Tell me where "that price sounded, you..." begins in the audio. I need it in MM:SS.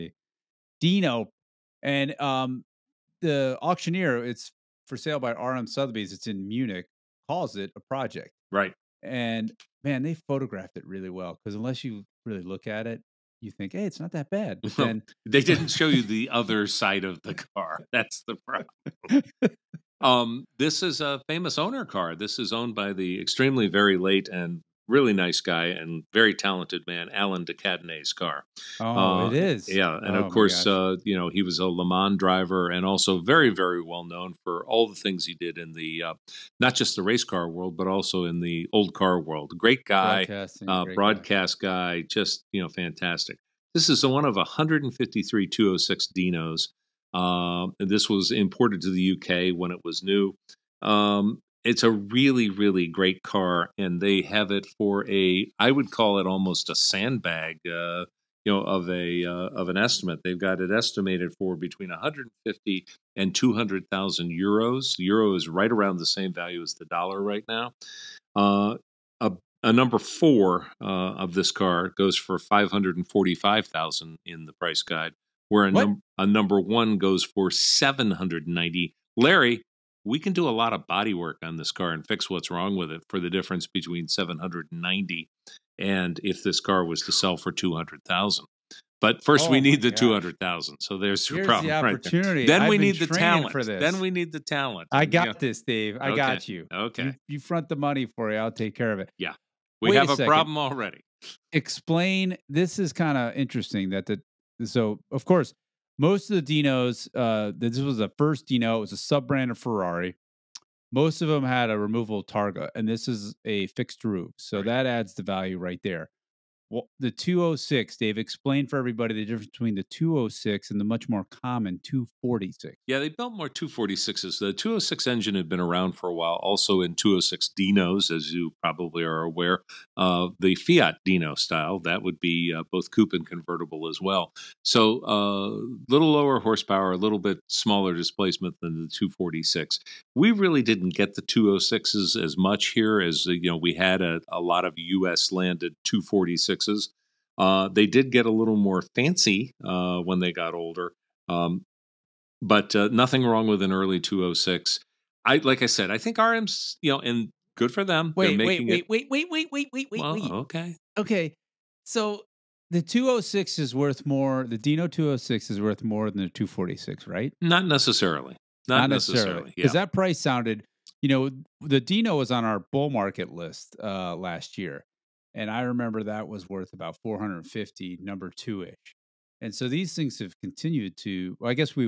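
02:49.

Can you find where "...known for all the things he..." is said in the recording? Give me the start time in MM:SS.
00:34.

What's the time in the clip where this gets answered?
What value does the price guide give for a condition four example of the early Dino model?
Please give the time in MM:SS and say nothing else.
01:12.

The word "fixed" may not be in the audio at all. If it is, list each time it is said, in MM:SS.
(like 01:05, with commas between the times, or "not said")
01:53.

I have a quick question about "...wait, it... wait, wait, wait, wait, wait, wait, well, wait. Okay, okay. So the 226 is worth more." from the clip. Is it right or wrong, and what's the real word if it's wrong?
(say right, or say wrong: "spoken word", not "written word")
wrong: "206", not "226".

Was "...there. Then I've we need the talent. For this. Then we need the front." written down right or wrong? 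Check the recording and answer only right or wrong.
wrong.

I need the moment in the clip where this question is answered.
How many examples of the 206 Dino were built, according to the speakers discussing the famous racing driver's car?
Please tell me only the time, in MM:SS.
00:44.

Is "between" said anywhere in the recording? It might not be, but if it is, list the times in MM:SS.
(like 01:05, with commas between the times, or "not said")
01:01, 01:23, 01:59.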